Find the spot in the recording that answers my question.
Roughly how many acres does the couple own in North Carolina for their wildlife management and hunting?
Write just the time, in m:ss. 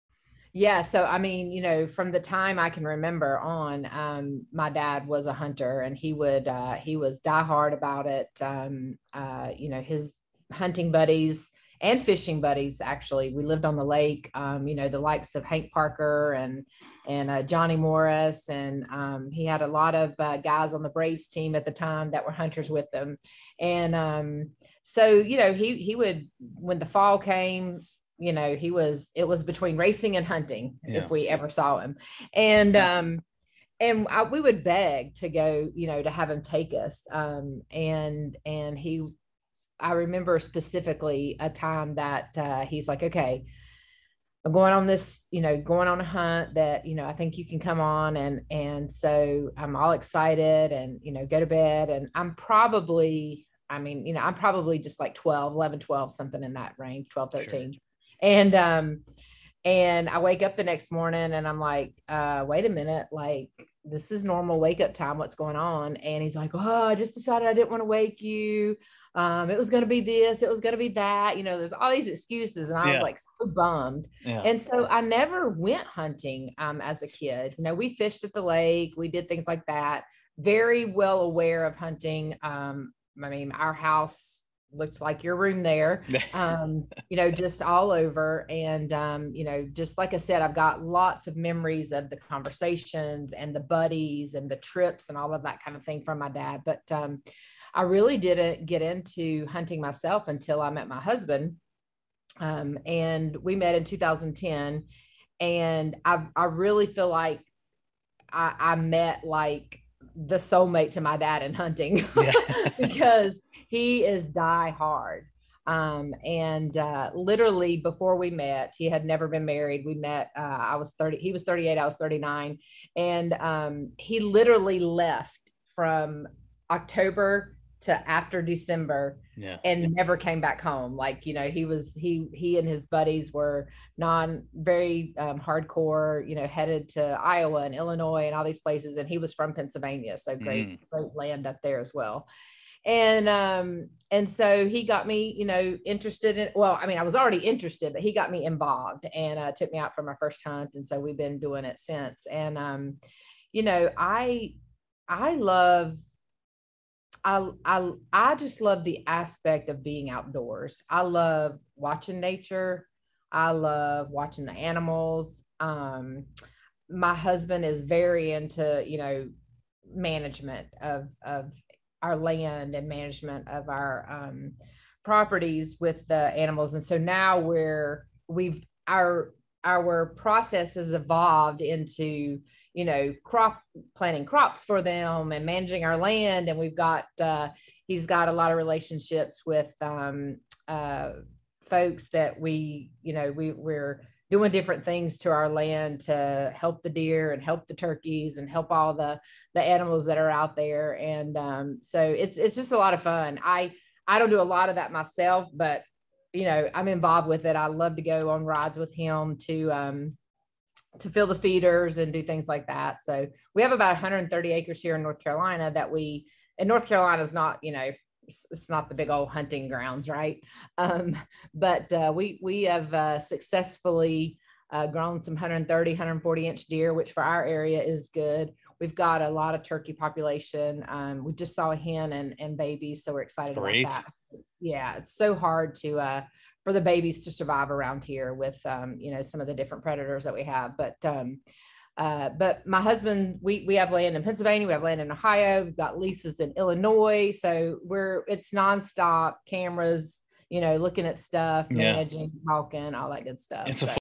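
3:33.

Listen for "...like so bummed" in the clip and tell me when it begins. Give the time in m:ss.
1:13.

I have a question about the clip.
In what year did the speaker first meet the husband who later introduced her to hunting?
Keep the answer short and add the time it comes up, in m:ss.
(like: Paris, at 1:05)
2010, at 1:43.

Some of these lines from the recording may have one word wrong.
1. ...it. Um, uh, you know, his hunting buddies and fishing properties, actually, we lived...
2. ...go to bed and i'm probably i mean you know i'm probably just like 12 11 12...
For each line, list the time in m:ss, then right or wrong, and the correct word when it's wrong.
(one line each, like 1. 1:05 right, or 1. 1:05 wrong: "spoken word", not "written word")
1. 0:08 wrong: "buddies", not "properties"
2. 0:51 right.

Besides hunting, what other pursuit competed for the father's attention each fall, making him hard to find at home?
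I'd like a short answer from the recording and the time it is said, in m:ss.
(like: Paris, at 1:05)
Racing, at 0:29.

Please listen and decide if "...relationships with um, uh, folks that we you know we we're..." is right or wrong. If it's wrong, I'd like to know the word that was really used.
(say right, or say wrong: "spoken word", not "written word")
right.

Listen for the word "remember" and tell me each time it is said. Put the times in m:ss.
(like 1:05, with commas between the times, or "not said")
0:02, 0:39.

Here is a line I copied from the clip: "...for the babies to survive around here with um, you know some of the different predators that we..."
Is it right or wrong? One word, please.
right.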